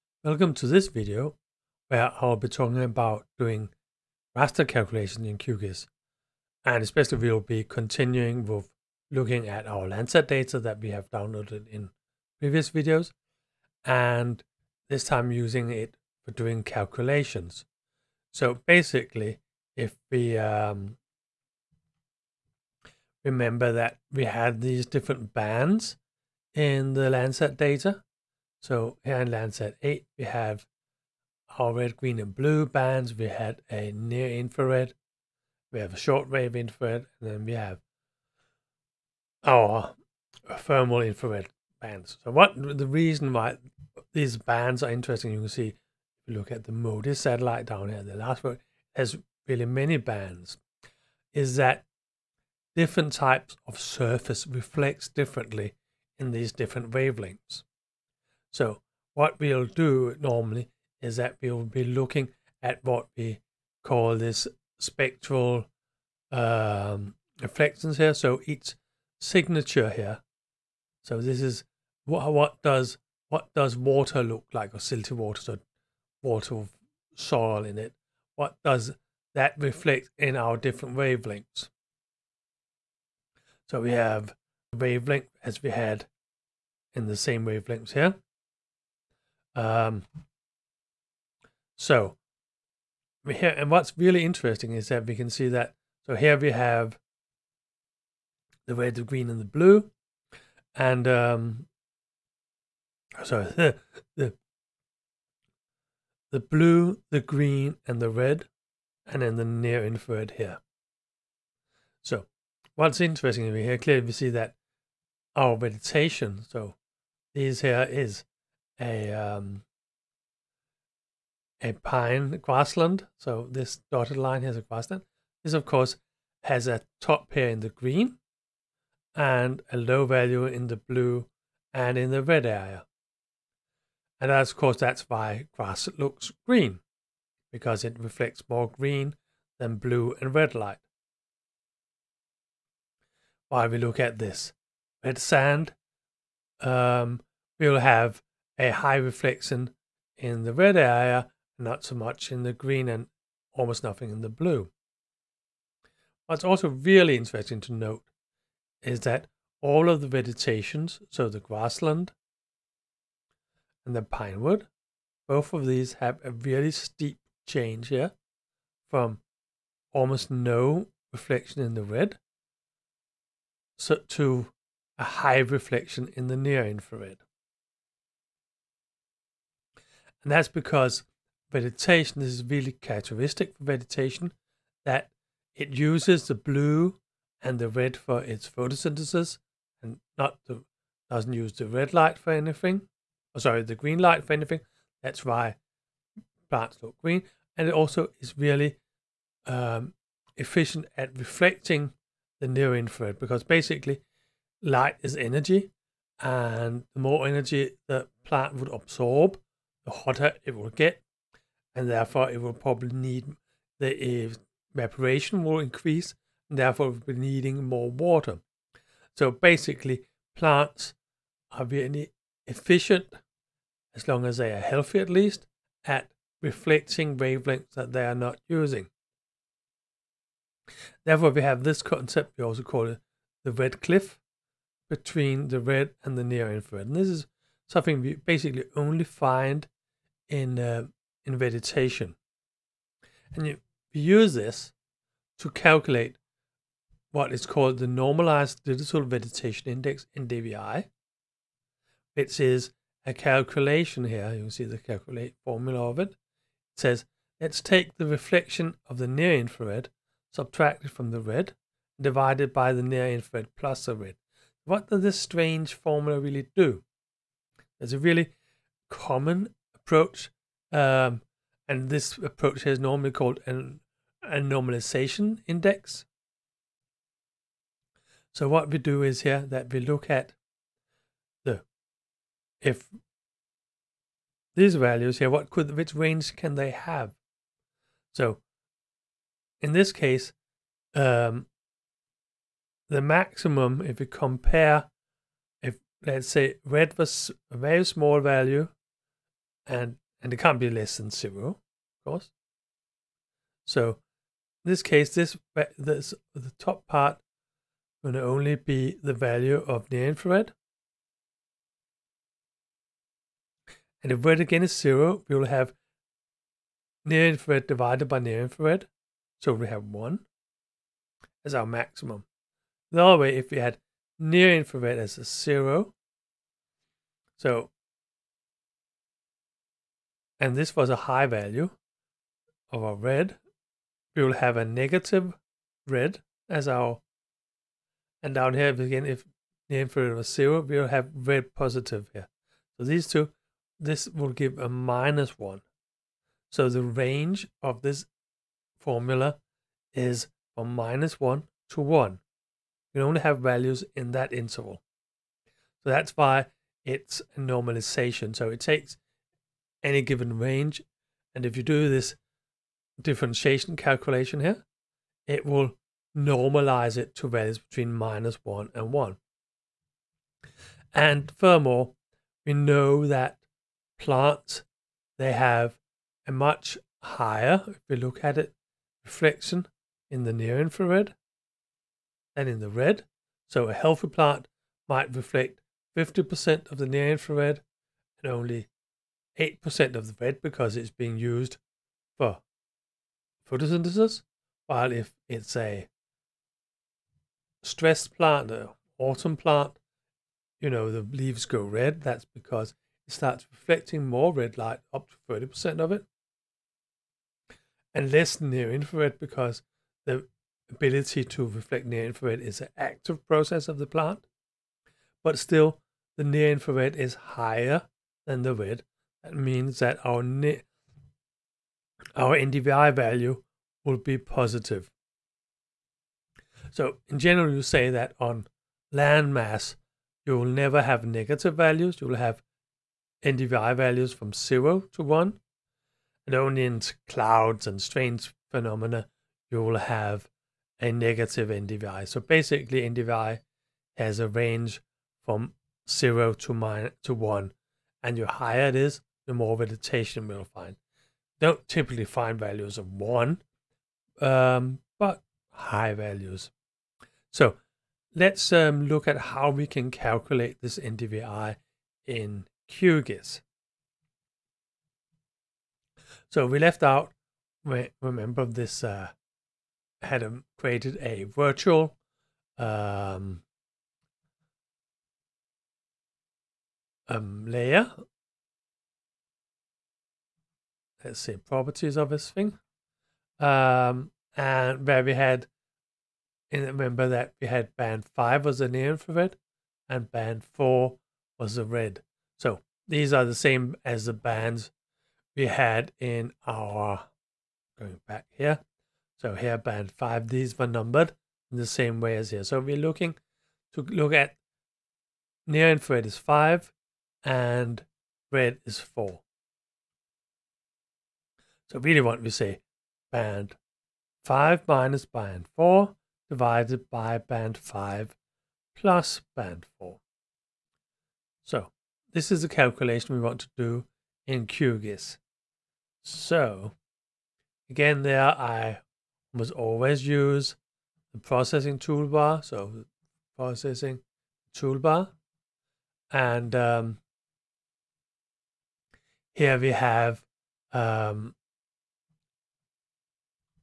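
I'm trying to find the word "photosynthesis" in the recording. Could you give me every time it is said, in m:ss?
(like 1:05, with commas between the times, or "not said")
3:08, 6:33.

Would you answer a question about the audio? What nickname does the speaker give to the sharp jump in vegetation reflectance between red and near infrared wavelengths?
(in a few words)
red cliff.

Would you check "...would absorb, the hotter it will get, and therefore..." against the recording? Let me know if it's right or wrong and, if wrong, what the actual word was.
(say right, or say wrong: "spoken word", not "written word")
right.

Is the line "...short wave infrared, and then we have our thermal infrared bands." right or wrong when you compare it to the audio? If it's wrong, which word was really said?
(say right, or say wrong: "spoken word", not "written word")
right.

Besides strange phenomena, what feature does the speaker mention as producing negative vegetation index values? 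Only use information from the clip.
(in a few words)
clouds.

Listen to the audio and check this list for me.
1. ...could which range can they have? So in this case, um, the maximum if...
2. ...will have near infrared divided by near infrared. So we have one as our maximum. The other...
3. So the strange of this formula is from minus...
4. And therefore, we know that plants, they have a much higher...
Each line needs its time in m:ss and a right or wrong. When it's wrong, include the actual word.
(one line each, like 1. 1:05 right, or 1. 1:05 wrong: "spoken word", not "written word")
1. 4:45 right
2. 5:15 right
3. 5:46 wrong: "range", not "strange"
4. 6:10 wrong: "furthermore", not "therefore".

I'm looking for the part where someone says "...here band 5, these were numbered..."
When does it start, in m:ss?
8:19.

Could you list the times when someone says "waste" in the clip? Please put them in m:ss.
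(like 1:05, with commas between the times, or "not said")
not said.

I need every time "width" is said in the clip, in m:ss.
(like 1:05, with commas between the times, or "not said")
not said.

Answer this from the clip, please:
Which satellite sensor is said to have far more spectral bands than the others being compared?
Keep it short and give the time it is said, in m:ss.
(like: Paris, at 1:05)
MODIS, at 0:46.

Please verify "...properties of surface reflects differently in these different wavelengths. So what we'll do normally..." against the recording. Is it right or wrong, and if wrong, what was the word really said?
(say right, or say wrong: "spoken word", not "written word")
wrong: "types", not "properties".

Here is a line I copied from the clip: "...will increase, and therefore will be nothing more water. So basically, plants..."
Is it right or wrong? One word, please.
wrong.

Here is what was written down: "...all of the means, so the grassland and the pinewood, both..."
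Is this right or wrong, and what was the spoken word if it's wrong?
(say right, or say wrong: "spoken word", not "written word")
wrong: "vegetations", not "means".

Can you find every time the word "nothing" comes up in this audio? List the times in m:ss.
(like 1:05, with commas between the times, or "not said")
2:33.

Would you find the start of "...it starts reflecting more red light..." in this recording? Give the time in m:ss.
6:43.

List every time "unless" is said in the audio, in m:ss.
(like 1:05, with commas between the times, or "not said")
not said.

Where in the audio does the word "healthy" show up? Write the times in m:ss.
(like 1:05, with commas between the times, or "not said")
3:44, 6:23.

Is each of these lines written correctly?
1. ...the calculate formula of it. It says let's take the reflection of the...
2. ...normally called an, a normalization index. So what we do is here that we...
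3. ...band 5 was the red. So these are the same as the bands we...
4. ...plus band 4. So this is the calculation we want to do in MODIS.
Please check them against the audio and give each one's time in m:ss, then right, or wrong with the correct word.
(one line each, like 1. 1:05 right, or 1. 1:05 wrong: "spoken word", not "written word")
1. 4:14 right
2. 4:32 right
3. 8:10 wrong: "4", not "5"
4. 8:38 wrong: "QGIS", not "MODIS".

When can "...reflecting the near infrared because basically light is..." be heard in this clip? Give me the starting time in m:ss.
3:21.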